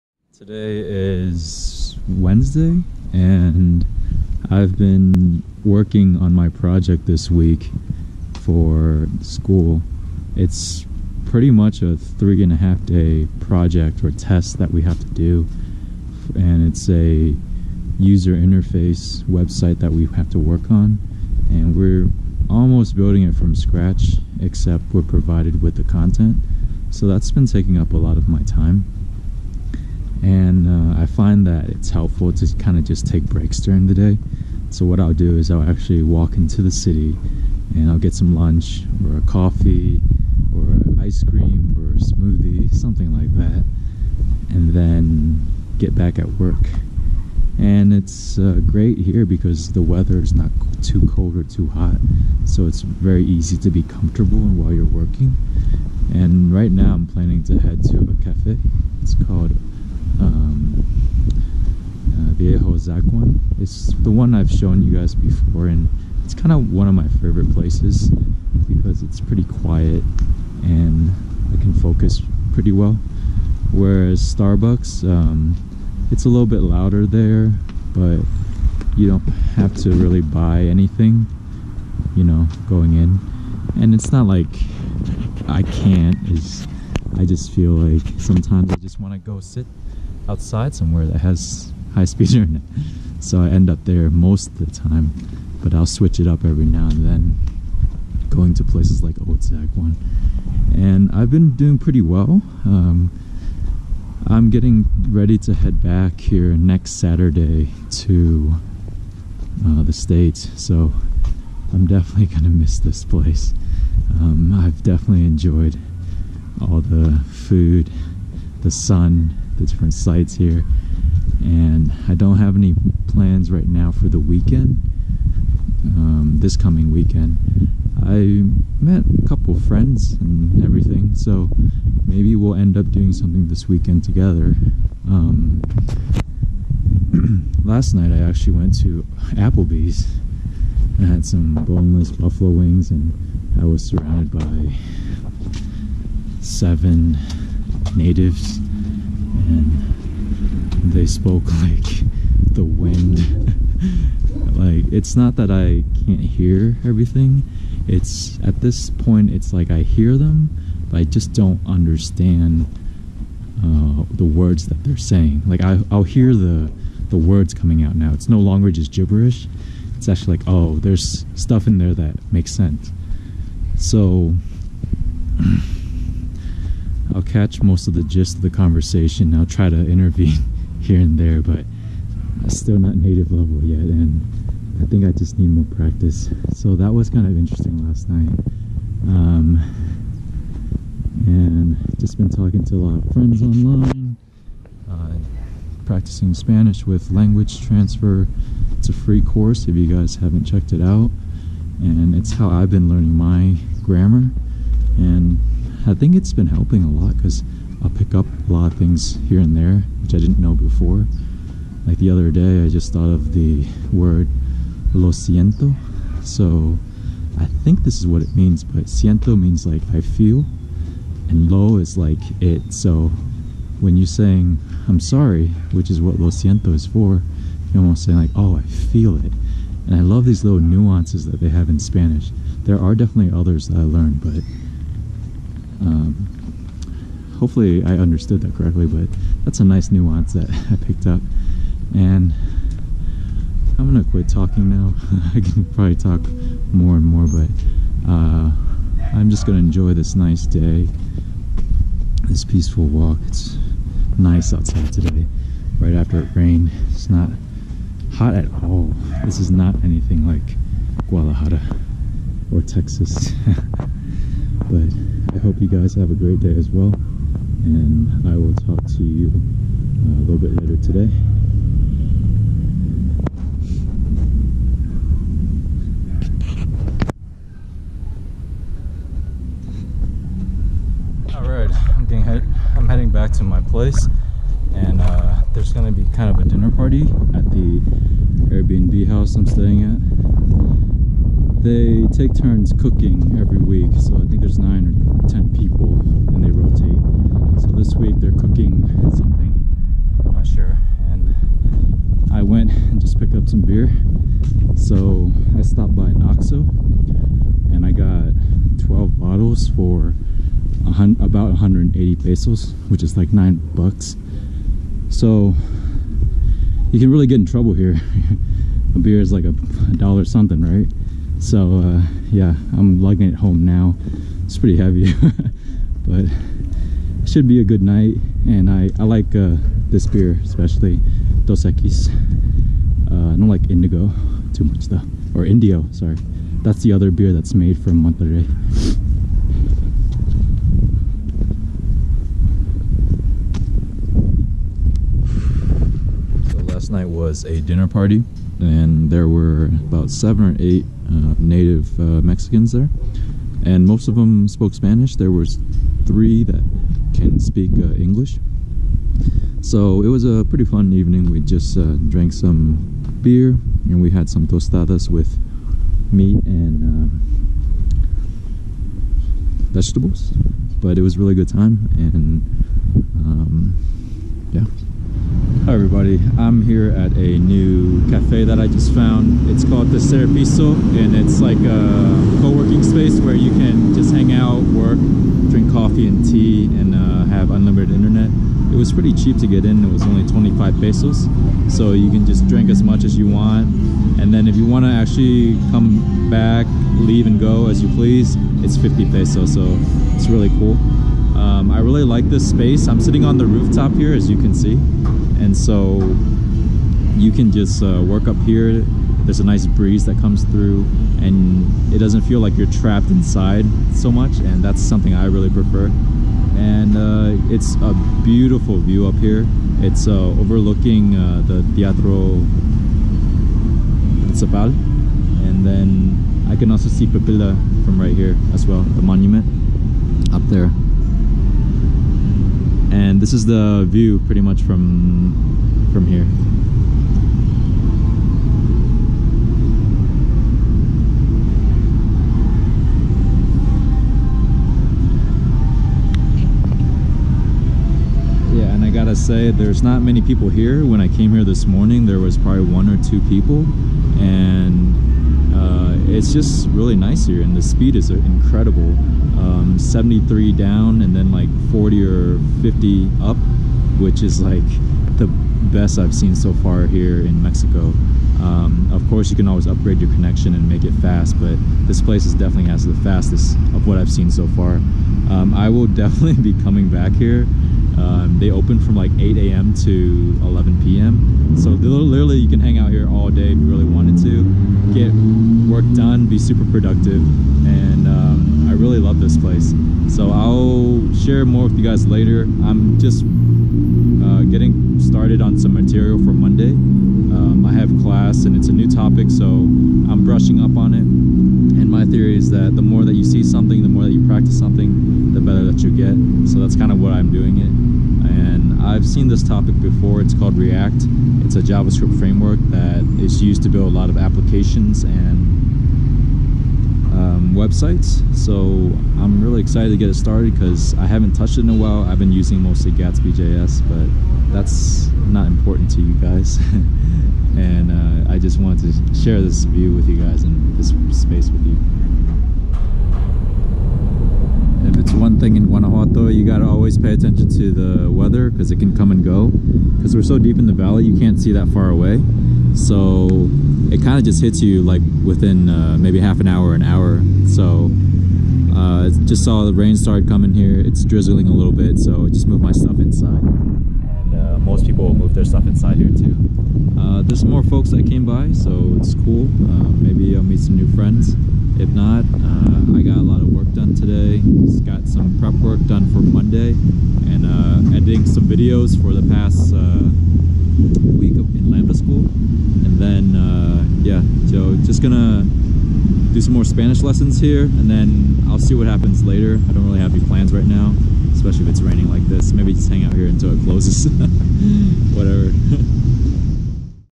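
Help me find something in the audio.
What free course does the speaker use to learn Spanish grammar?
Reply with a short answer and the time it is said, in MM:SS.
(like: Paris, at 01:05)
Language Transfer, at 03:17.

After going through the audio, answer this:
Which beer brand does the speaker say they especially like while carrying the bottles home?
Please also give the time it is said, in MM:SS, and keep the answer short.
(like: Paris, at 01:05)
Dos Equis, at 05:31.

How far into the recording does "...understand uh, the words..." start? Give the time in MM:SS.
02:41.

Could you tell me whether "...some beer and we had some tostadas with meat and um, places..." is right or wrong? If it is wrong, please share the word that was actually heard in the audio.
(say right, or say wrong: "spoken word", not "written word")
wrong: "vegetables", not "places".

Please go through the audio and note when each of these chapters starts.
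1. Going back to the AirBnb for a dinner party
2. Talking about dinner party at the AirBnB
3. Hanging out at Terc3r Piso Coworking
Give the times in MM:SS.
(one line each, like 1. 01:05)
1. 04:42
2. 05:46
3. 06:14.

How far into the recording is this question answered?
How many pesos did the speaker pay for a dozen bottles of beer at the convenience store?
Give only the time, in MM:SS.
05:11.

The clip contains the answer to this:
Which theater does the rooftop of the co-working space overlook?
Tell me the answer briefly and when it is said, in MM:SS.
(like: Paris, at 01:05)
Teatro Principal, at 07:01.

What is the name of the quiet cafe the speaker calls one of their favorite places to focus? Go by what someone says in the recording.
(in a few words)
Viejo Zaguán.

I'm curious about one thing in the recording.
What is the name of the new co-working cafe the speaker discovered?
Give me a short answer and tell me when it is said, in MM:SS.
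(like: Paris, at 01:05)
the Piso, at 06:19.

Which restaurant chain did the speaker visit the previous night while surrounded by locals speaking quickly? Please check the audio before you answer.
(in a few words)
Applebee's.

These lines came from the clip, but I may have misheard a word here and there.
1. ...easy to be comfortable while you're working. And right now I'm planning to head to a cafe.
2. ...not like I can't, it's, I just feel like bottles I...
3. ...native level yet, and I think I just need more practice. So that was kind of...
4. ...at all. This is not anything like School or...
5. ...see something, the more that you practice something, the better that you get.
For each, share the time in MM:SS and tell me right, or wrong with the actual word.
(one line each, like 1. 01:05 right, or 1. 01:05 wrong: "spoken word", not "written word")
1. 00:53 right
2. 01:24 wrong: "sometimes", not "bottles"
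3. 03:02 right
4. 04:18 wrong: "Guadalajara", not "School"
5. 08:23 right.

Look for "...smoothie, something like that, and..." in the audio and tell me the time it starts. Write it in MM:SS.
00:41.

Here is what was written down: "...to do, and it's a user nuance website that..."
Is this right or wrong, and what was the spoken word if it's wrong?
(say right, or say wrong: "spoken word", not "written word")
wrong: "interface", not "nuance".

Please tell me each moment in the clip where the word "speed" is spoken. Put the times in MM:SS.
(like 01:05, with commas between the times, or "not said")
01:32, 07:37.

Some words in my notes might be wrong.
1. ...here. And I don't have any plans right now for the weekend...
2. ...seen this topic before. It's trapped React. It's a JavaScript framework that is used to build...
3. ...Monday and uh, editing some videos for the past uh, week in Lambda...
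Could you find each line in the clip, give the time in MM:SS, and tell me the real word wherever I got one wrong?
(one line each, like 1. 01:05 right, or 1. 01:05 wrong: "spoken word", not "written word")
1. 02:00 right
2. 08:29 wrong: "called", not "trapped"
3. 09:26 right.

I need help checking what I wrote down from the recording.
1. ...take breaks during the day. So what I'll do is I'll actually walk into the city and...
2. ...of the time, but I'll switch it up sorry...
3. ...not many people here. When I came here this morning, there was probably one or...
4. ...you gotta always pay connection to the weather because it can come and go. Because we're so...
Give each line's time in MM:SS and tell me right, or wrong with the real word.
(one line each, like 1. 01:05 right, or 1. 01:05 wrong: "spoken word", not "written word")
1. 00:33 right
2. 01:34 wrong: "every", not "sorry"
3. 07:29 right
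4. 08:56 wrong: "attention", not "connection".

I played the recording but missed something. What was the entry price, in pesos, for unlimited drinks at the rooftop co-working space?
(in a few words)
25 pesos.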